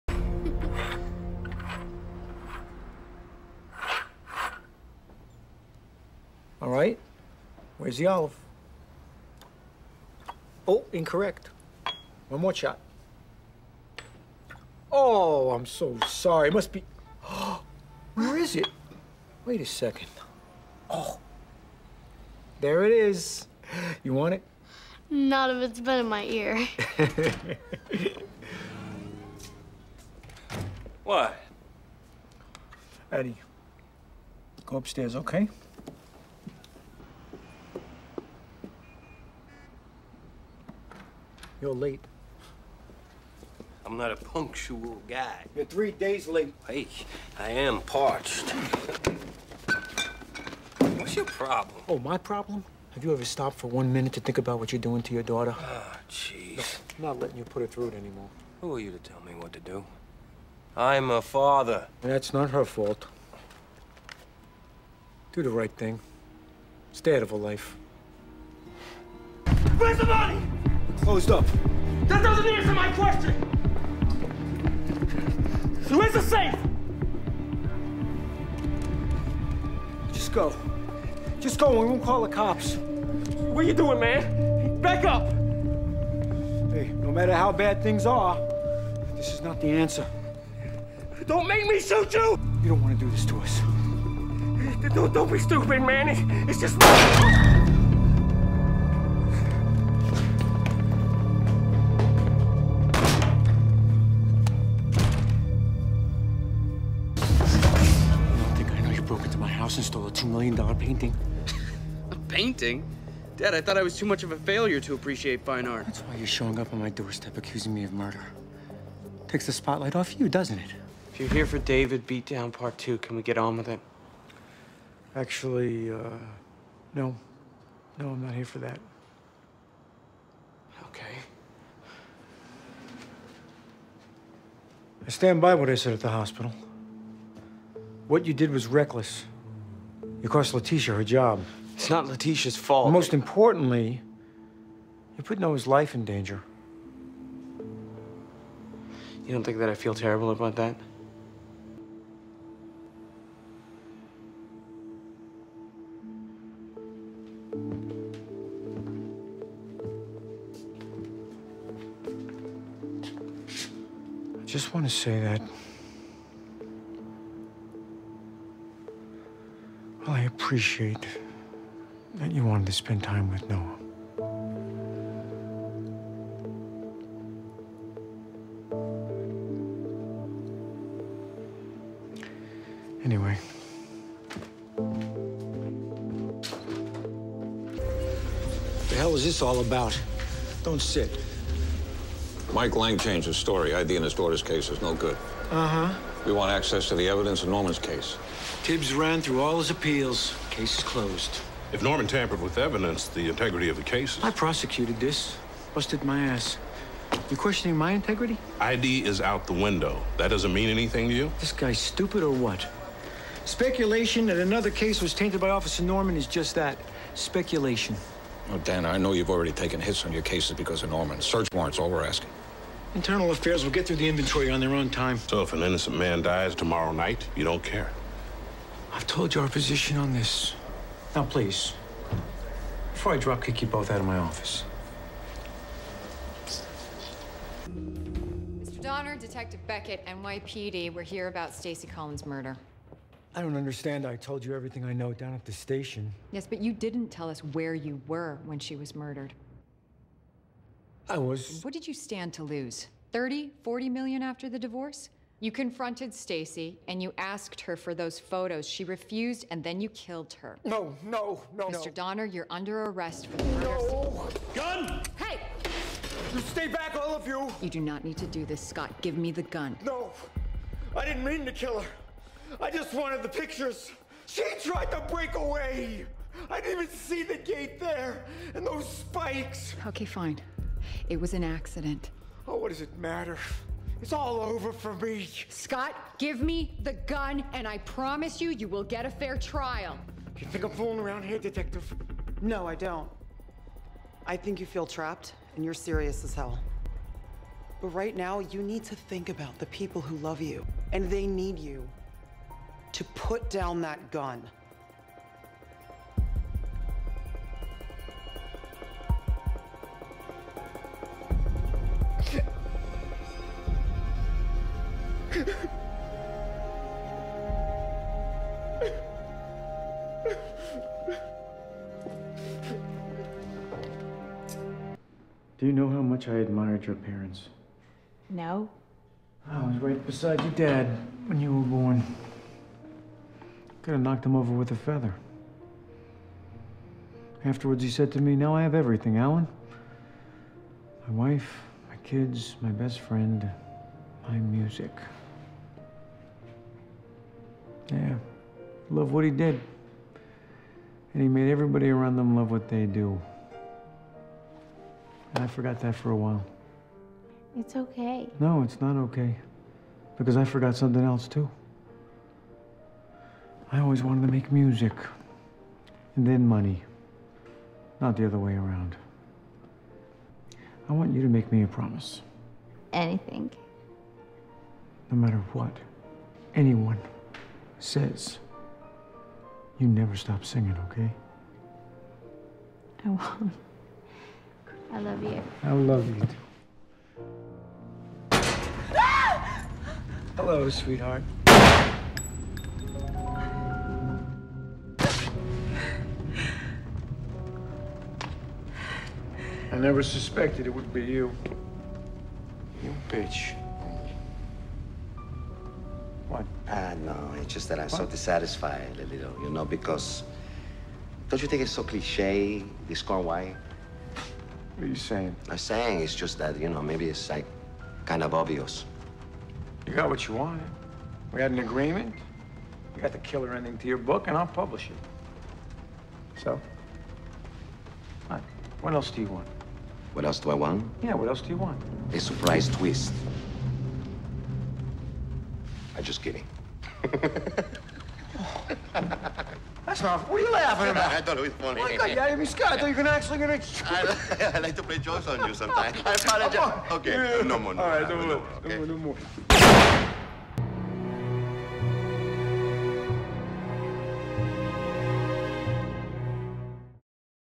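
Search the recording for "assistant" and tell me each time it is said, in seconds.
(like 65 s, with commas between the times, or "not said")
not said.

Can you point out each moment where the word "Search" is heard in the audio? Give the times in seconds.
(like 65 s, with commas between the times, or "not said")
221 s.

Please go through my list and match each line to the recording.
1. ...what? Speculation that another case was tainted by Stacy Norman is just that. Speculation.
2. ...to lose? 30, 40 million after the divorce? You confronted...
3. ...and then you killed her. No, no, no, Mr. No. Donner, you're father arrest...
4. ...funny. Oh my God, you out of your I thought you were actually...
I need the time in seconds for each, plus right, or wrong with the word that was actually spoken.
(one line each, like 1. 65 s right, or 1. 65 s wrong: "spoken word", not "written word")
1. 212 s wrong: "Officer", not "Stacy"
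2. 252 s right
3. 259 s wrong: "under", not "father"
4. 441 s right.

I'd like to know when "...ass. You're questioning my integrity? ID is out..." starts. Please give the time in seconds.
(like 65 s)
206 s.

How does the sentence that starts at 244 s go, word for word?
I told you everything I know down at the station.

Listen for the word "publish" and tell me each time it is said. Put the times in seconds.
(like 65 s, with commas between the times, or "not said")
424 s.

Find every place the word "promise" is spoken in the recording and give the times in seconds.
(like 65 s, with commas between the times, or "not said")
287 s, 371 s.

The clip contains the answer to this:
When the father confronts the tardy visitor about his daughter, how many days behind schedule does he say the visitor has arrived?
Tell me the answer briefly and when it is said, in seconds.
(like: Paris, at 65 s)
3 days, at 45 s.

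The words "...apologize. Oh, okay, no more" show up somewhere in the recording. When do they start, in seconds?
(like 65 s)
446 s.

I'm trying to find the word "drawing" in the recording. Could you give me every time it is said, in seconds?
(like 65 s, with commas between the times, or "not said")
not said.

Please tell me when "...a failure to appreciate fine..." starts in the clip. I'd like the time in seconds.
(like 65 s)
114 s.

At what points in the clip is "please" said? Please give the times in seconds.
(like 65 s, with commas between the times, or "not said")
231 s.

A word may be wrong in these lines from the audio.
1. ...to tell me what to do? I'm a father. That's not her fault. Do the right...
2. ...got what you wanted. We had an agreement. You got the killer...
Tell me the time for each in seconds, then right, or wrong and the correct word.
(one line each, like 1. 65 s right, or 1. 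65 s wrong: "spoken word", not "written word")
1. 58 s right
2. 419 s right.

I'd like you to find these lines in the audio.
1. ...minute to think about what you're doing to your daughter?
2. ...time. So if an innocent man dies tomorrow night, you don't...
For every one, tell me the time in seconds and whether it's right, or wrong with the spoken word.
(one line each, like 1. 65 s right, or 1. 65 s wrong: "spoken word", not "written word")
1. 53 s right
2. 224 s right.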